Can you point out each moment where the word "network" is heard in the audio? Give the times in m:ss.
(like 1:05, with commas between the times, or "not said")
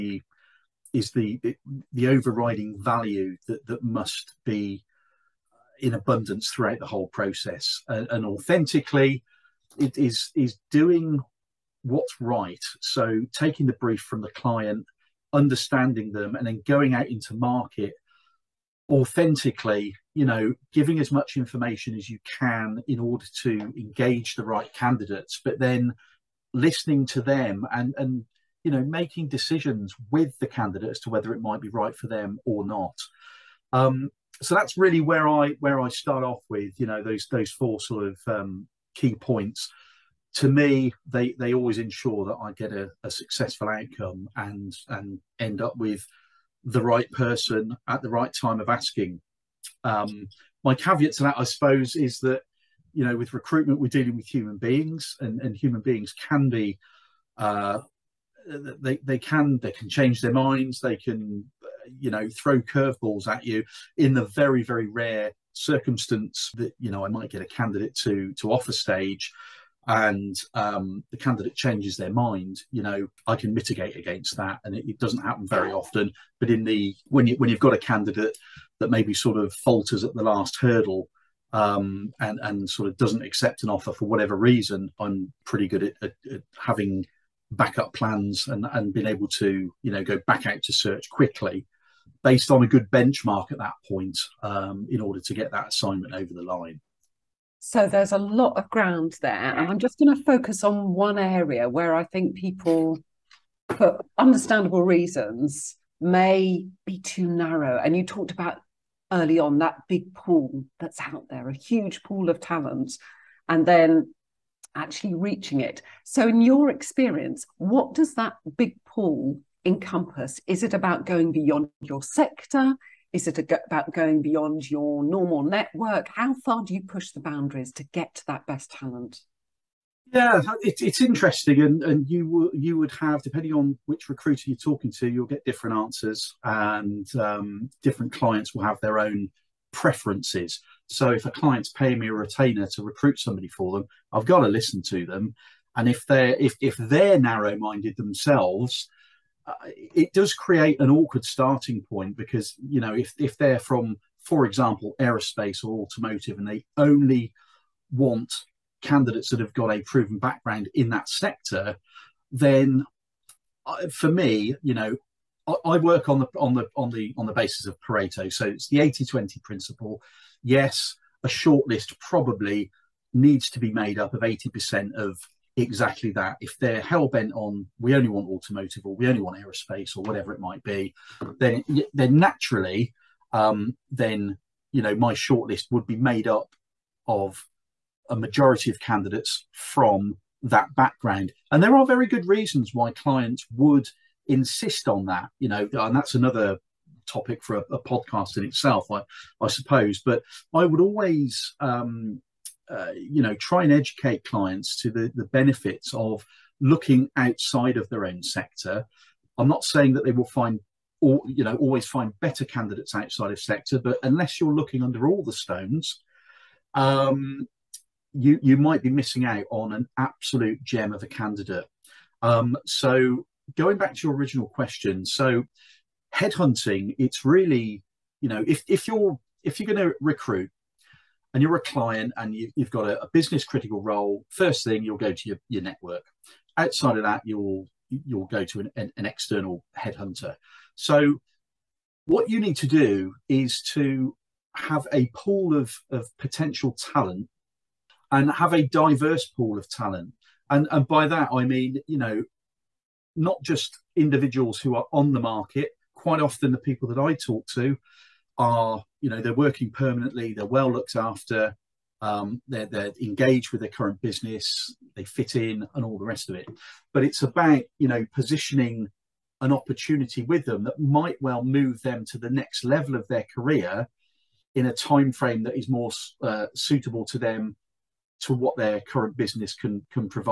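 2:05, 3:55.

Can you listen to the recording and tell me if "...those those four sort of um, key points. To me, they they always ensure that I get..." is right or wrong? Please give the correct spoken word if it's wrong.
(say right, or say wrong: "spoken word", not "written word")
right.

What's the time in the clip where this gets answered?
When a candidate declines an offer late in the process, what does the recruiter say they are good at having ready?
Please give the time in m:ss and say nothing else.
1:27.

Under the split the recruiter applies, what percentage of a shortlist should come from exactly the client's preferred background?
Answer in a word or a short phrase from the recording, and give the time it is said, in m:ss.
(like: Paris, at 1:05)
80%, at 2:54.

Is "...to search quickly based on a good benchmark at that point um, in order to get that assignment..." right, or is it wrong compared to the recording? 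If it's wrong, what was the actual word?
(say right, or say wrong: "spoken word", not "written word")
right.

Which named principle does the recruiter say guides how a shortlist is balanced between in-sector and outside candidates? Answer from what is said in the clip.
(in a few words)
Pareto.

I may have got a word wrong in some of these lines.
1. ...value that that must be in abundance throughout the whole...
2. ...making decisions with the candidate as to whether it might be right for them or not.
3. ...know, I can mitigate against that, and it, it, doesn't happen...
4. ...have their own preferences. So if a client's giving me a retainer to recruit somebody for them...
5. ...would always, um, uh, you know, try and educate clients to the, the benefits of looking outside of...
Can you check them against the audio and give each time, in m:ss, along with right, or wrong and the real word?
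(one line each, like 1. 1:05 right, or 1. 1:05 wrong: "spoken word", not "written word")
1. 0:02 right
2. 0:28 right
3. 1:12 right
4. 2:18 wrong: "paying", not "giving"
5. 3:20 right.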